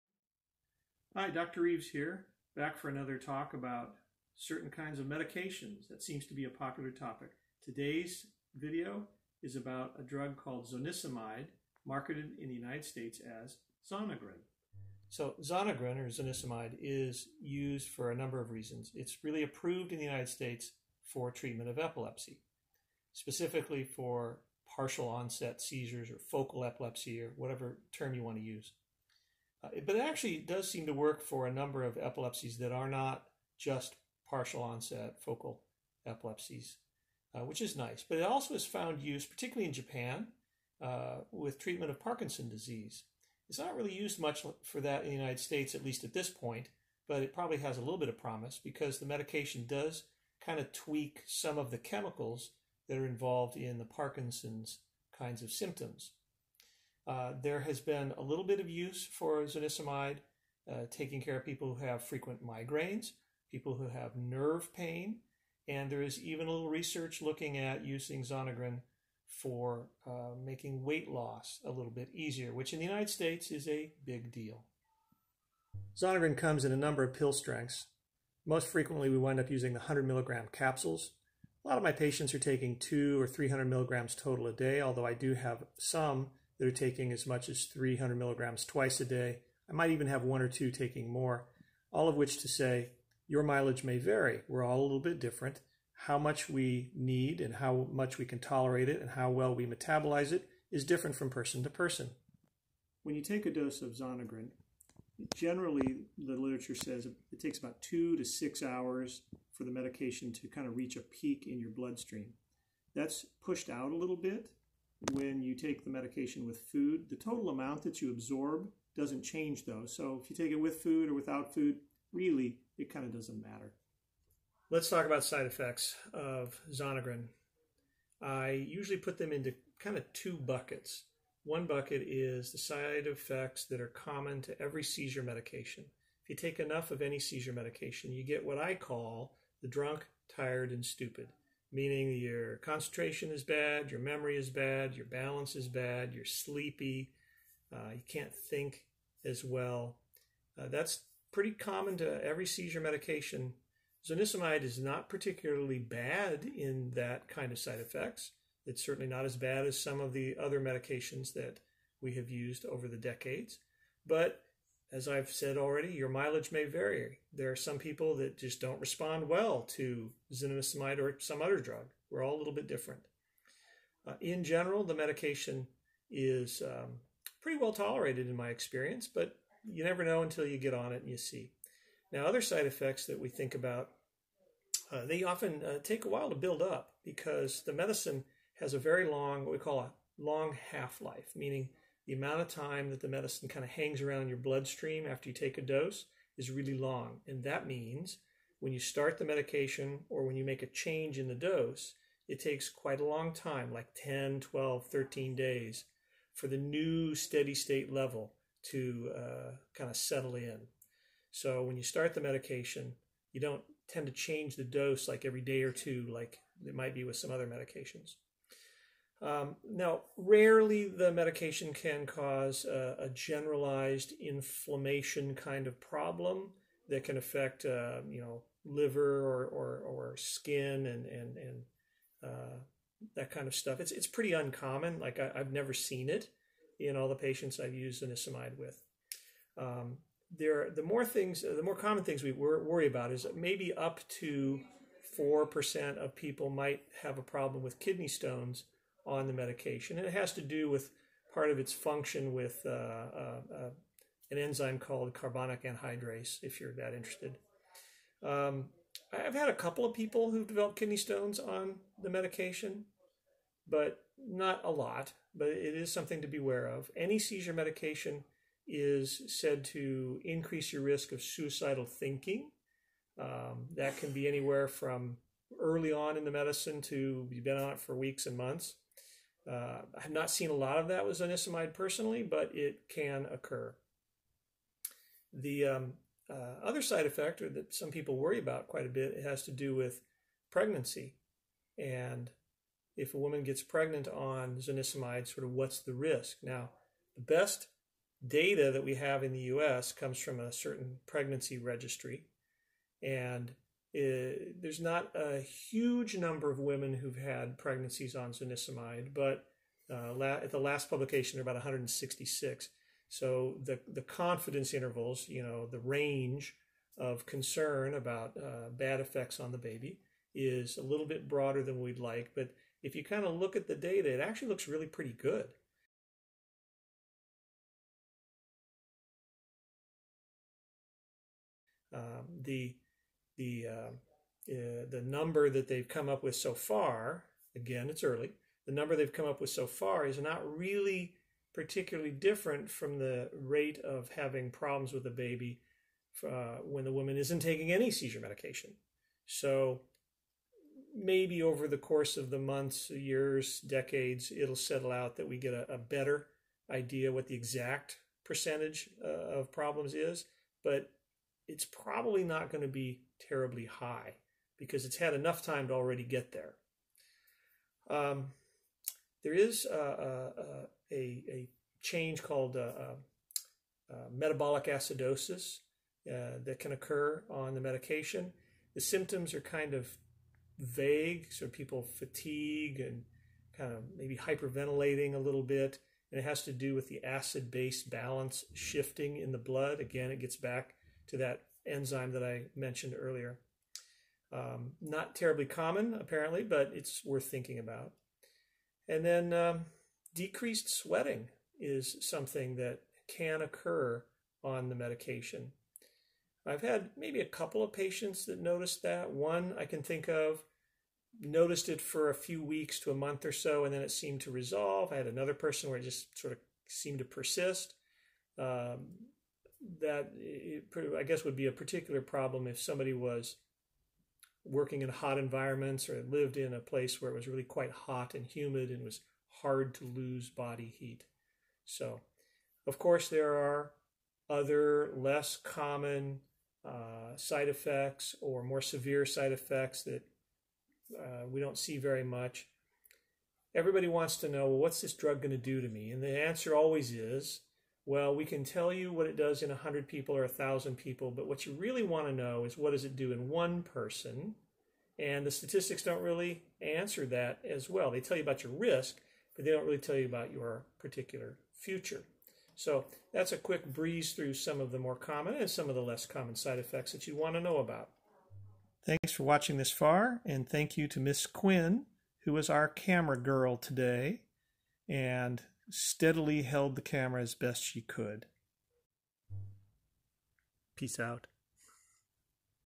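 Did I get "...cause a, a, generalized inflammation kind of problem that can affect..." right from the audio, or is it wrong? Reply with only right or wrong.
right.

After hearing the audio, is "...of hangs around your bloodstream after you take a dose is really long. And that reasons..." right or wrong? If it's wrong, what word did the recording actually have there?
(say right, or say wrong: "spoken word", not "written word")
wrong: "means", not "reasons".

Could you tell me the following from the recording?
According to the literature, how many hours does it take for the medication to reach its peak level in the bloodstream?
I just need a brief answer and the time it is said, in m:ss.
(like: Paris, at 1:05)
2 to 6 hours, at 1:47.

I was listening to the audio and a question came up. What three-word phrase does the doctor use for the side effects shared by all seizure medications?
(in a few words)
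drunk, tired, and stupid.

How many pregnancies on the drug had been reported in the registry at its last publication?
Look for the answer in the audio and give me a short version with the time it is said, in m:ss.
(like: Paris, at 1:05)
166, at 5:11.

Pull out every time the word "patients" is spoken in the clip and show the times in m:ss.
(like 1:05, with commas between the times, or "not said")
1:21, 3:57, 6:47.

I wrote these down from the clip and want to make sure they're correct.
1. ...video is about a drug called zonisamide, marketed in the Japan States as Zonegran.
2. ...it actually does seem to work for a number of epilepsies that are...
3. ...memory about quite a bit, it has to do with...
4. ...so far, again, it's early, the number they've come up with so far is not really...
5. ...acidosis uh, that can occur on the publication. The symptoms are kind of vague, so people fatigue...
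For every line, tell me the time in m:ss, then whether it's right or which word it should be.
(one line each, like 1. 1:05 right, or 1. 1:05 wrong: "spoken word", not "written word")
1. 0:08 wrong: "United", not "Japan"
2. 0:29 right
3. 4:48 wrong: "worry", not "memory"
4. 5:36 right
5. 6:14 wrong: "medication", not "publication".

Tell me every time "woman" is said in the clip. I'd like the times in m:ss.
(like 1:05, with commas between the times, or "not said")
4:53, 5:46.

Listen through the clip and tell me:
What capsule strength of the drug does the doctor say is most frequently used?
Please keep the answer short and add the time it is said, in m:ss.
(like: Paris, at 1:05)
100 milligrams, at 1:19.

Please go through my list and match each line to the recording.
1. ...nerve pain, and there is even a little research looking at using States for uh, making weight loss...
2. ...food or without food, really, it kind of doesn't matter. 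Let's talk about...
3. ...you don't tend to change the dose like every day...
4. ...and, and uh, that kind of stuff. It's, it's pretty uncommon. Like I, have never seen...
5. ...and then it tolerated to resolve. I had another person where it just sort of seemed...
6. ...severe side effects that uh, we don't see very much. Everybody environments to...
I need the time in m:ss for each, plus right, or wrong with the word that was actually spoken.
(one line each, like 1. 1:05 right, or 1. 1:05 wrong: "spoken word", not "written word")
1. 1:04 wrong: "Zonegran", not "States"
2. 2:00 right
3. 3:33 right
4. 3:51 right
5. 6:53 wrong: "seemed", not "tolerated"
6. 7:18 wrong: "wants", not "environments".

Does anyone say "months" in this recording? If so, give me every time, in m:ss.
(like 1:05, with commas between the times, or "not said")
4:38, 5:52, 6:52.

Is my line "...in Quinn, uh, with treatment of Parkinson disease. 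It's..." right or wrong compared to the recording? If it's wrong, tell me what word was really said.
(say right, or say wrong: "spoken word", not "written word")
wrong: "Japan", not "Quinn".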